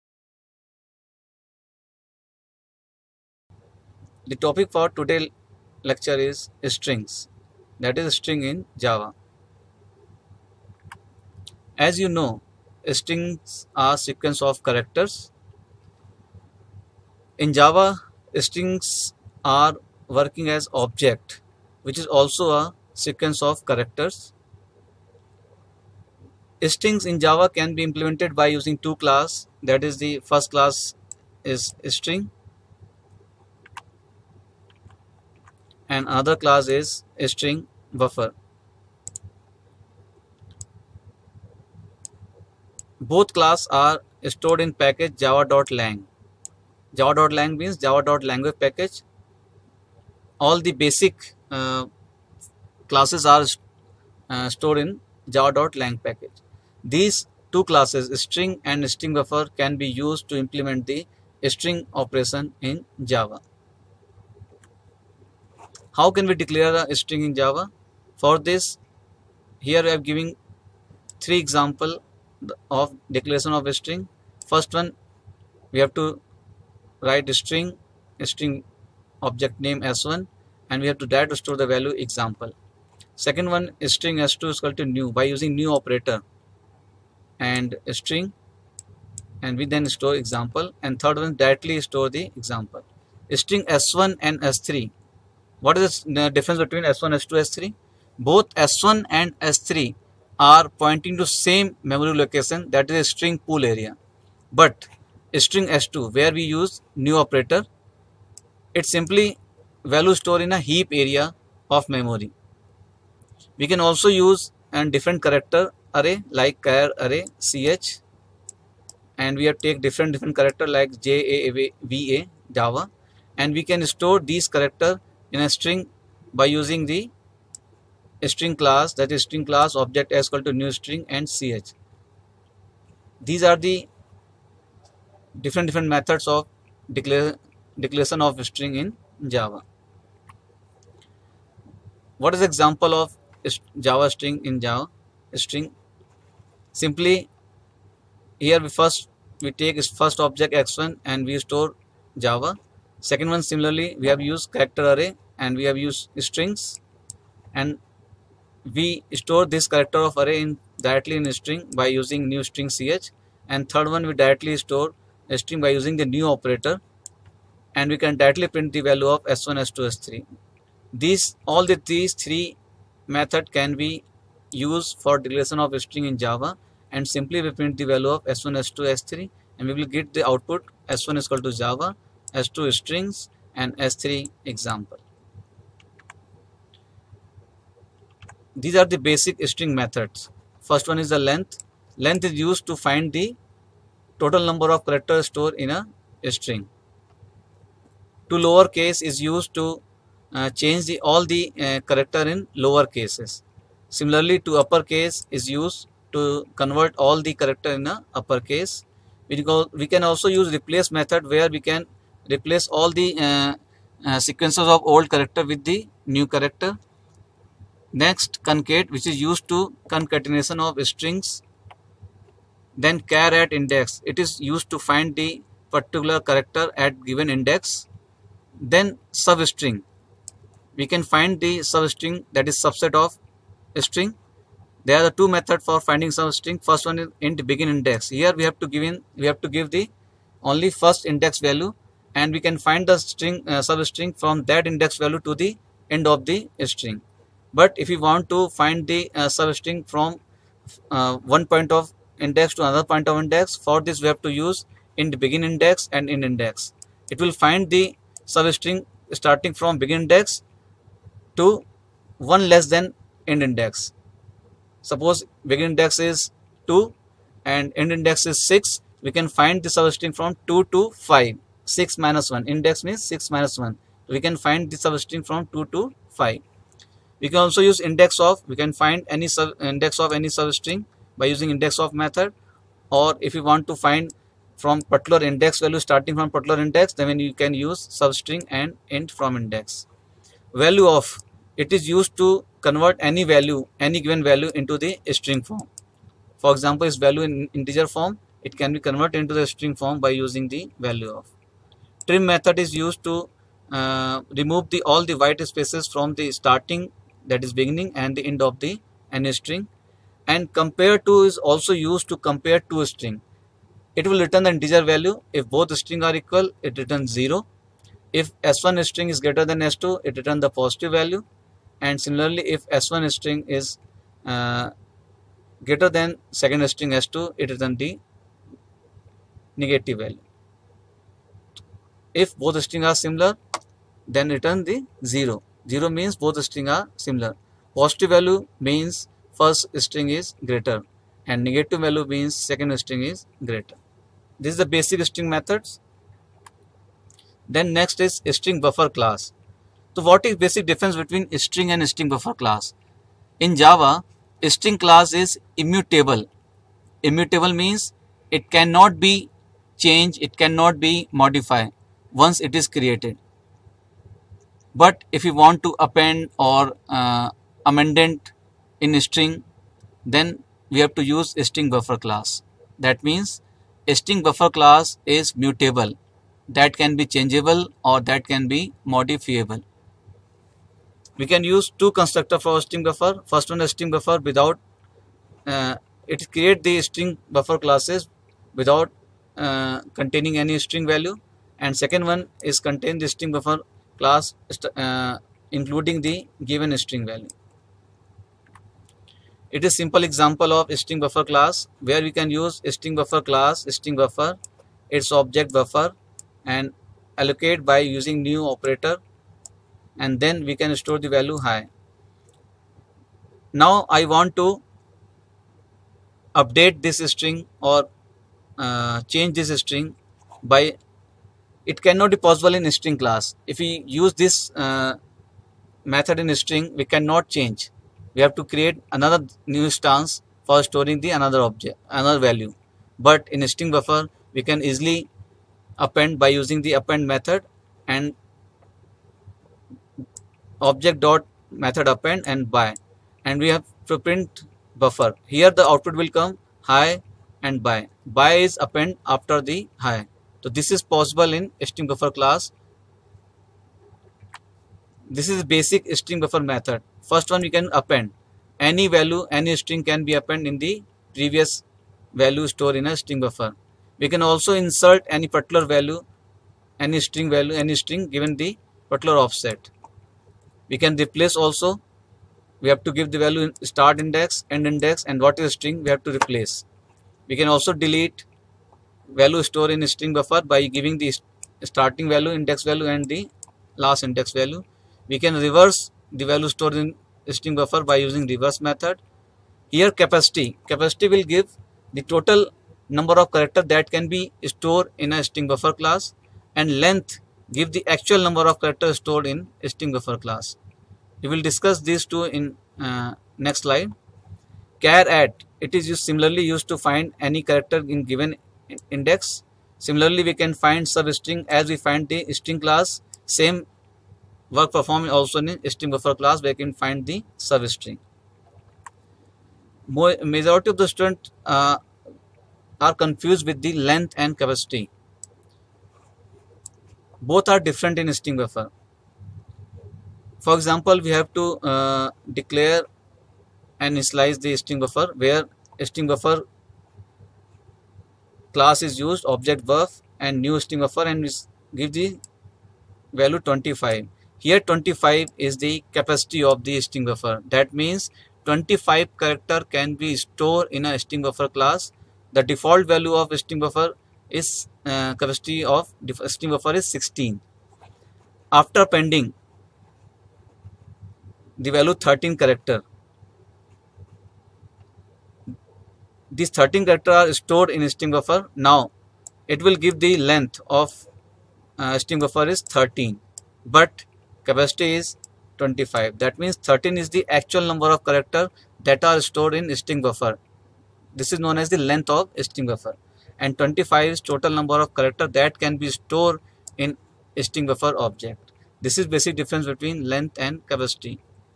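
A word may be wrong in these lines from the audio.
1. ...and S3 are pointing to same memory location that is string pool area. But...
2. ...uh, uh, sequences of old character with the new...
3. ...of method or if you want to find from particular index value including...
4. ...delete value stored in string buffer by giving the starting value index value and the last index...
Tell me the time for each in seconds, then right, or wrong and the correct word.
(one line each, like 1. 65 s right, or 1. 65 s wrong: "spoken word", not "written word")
1. 99 s right
2. 213 s right
3. 281 s wrong: "starting", not "including"
4. 477 s right.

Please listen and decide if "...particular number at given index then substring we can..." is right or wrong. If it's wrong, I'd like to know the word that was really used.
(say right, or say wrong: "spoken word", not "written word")
wrong: "character", not "number".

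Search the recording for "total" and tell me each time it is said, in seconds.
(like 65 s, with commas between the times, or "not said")
194 s, 492 s, 584 s.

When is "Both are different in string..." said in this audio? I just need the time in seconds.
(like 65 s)
527 s.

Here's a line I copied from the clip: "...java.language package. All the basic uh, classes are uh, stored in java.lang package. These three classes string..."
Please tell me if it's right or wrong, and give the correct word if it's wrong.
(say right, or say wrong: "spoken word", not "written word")
wrong: "two", not "three".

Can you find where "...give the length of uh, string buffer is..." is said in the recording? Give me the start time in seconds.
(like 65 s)
569 s.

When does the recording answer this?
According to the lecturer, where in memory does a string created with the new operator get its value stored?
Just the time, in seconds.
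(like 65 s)
110 s.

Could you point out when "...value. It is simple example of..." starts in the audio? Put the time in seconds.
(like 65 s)
397 s.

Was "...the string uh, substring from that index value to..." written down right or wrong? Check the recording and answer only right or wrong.
right.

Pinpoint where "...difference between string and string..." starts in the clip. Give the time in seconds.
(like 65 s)
350 s.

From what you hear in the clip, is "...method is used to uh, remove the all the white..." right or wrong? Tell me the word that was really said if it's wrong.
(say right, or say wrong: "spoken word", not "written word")
right.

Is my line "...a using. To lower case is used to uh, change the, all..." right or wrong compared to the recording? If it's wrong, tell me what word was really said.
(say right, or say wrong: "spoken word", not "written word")
wrong: "string", not "using".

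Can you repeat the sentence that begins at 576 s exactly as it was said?
That means 13 is the actual number of character that are stored in string buffer.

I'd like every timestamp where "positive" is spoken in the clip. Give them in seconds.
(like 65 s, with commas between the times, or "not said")
320 s, 337 s.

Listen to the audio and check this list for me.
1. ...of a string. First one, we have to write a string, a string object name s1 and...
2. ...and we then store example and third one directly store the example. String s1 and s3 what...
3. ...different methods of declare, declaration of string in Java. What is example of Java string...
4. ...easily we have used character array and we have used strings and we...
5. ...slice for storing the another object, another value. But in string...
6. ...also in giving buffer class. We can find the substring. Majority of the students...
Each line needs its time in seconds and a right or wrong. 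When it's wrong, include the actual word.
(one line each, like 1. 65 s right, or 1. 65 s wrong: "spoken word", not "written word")
1. 73 s right
2. 89 s right
3. 135 s right
4. 153 s wrong: "similarly", not "easily"
5. 429 s wrong: "stance", not "slice"
6. 515 s wrong: "string", not "giving".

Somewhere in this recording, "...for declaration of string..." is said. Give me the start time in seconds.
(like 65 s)
175 s.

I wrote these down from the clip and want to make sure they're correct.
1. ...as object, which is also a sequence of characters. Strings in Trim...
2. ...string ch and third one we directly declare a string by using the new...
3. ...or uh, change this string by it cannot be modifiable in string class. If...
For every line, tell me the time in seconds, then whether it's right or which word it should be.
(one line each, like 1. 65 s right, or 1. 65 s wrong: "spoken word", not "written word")
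1. 20 s wrong: "Java", not "Trim"
2. 162 s wrong: "store", not "declare"
3. 417 s wrong: "possible", not "modifiable".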